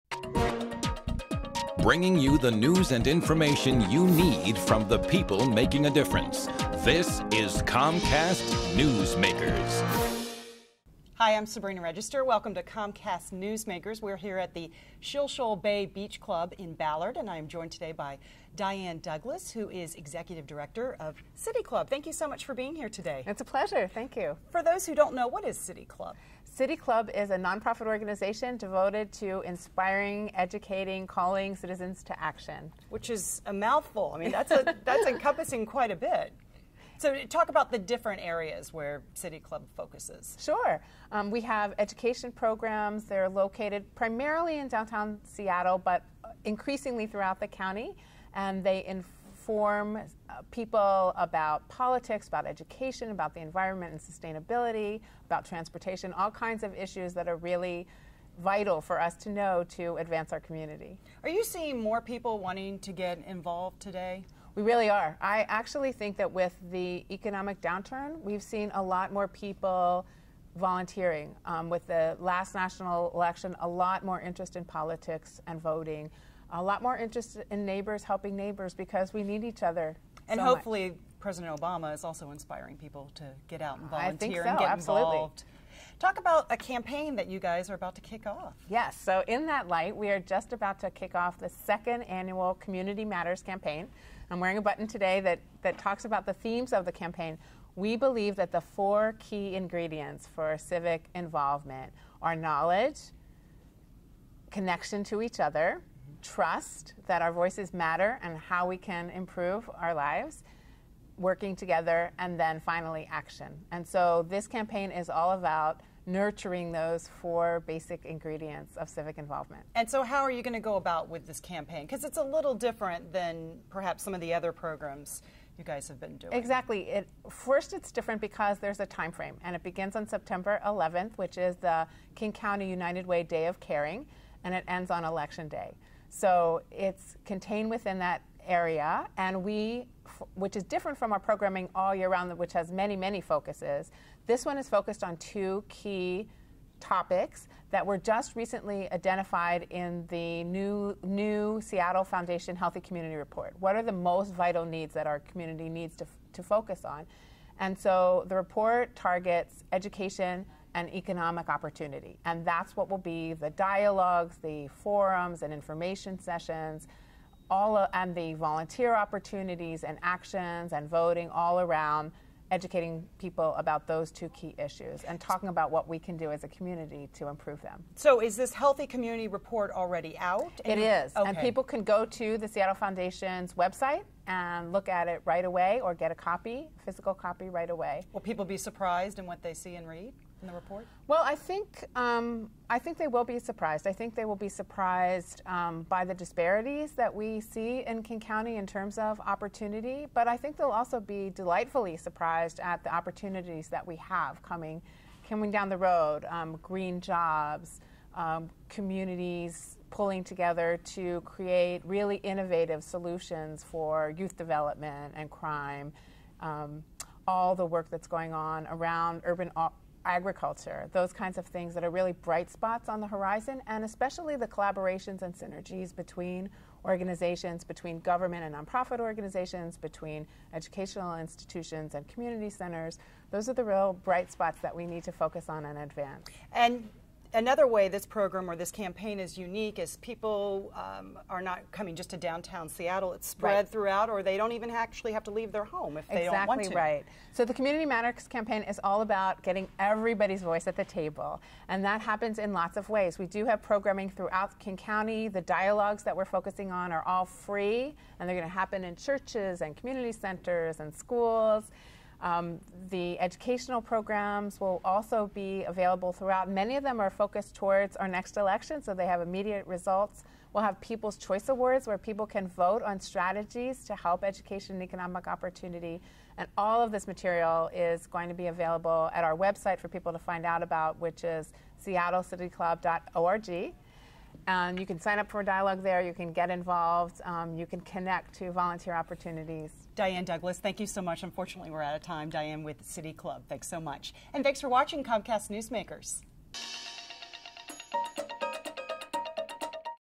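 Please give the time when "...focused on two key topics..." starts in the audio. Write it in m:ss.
2:24.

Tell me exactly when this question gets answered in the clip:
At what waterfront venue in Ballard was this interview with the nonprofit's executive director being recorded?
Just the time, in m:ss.
0:15.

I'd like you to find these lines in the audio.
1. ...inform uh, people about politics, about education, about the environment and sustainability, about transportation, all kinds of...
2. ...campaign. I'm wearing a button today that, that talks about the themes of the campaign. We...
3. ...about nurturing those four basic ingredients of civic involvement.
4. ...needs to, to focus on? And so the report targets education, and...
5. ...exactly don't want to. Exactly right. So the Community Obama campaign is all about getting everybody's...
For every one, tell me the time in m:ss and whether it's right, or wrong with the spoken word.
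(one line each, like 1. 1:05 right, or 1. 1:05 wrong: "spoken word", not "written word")
1. 0:49 right
2. 1:33 right
3. 1:55 right
4. 2:35 right
5. 4:06 wrong: "Matters", not "Obama".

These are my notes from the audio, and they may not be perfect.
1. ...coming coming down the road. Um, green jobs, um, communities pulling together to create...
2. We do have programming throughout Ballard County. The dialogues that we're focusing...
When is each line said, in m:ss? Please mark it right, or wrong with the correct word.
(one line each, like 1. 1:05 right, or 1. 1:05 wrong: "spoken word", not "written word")
1. 3:24 right
2. 4:13 wrong: "King", not "Ballard".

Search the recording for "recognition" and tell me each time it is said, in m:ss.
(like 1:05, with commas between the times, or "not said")
not said.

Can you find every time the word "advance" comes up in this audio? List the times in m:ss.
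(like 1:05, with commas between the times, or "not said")
0:59, 3:55.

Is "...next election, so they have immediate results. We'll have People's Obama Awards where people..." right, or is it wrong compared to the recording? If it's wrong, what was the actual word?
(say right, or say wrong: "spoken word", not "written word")
wrong: "Choice", not "Obama".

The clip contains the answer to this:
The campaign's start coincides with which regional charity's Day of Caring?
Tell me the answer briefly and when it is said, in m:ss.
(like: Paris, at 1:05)
King County United Way, at 2:12.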